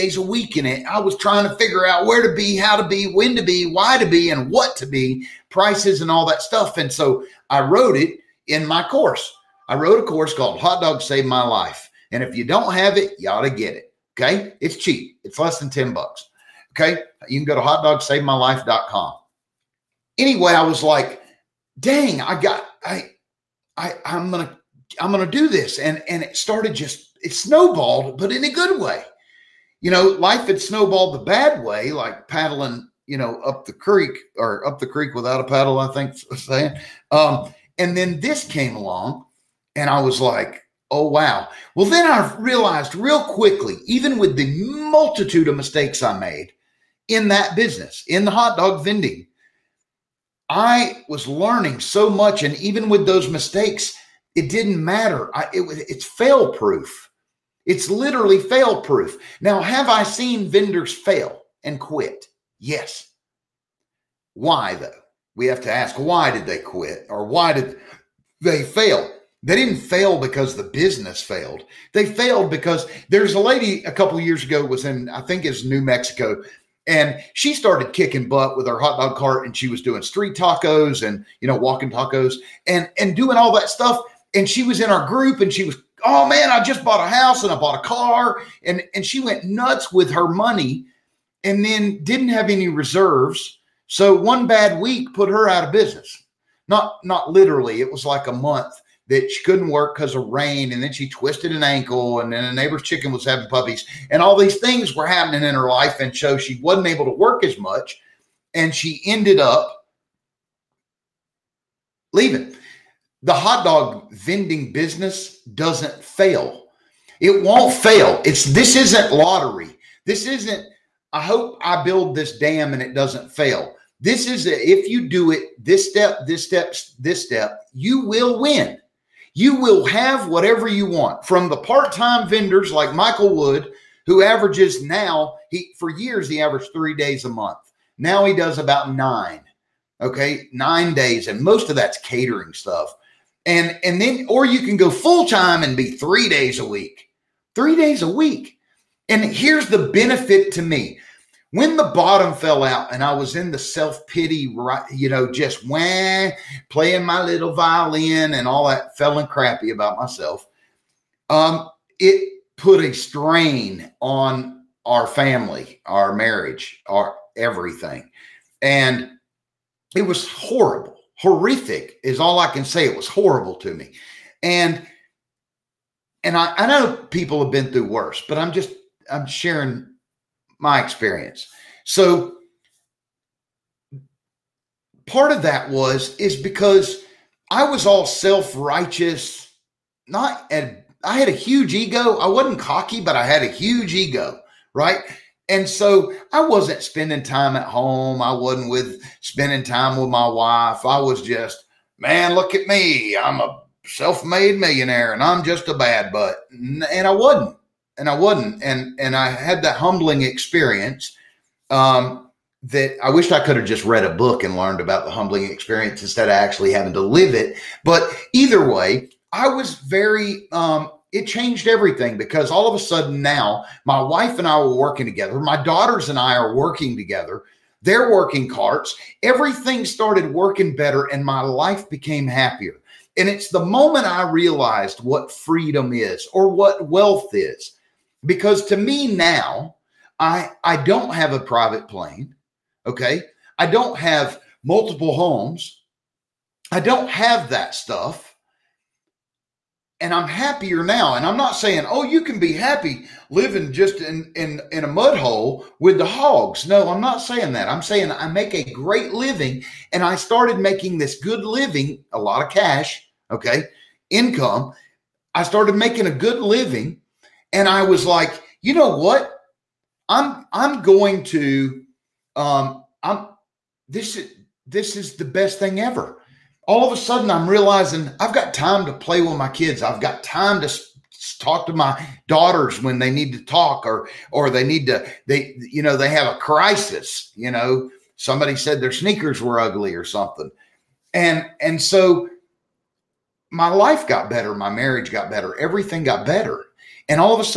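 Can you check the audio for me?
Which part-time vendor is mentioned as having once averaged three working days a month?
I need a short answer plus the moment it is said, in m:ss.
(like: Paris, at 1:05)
Michael Wood, at 2:12.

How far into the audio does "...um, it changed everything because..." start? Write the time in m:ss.
3:40.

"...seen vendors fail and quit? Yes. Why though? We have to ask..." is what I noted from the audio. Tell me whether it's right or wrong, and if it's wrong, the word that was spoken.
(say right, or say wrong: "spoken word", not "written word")
right.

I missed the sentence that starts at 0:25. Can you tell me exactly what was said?
And, and it started just, it snowballed, but in a good way.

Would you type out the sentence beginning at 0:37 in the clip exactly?
Um, and then this came along and I was like, oh, wow.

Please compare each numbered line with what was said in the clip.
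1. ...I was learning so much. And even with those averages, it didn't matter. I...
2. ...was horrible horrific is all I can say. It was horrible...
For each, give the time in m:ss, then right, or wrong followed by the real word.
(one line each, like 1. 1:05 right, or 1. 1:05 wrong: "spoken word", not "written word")
1. 0:50 wrong: "mistakes", not "averages"
2. 2:50 right.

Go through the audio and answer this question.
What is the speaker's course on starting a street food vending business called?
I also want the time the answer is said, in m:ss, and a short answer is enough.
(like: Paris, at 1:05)
Hot Dog Saved My Life, at 0:10.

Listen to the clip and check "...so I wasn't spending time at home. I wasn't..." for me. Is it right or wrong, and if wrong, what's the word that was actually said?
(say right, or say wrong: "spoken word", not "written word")
right.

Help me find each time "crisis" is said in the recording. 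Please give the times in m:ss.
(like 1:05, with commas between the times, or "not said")
4:46.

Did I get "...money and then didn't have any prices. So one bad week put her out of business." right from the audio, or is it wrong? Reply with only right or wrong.
wrong.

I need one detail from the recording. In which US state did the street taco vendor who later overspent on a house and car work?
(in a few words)
New Mexico.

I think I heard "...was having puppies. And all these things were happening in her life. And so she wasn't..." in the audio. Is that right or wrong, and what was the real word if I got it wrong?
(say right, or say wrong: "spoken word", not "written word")
right.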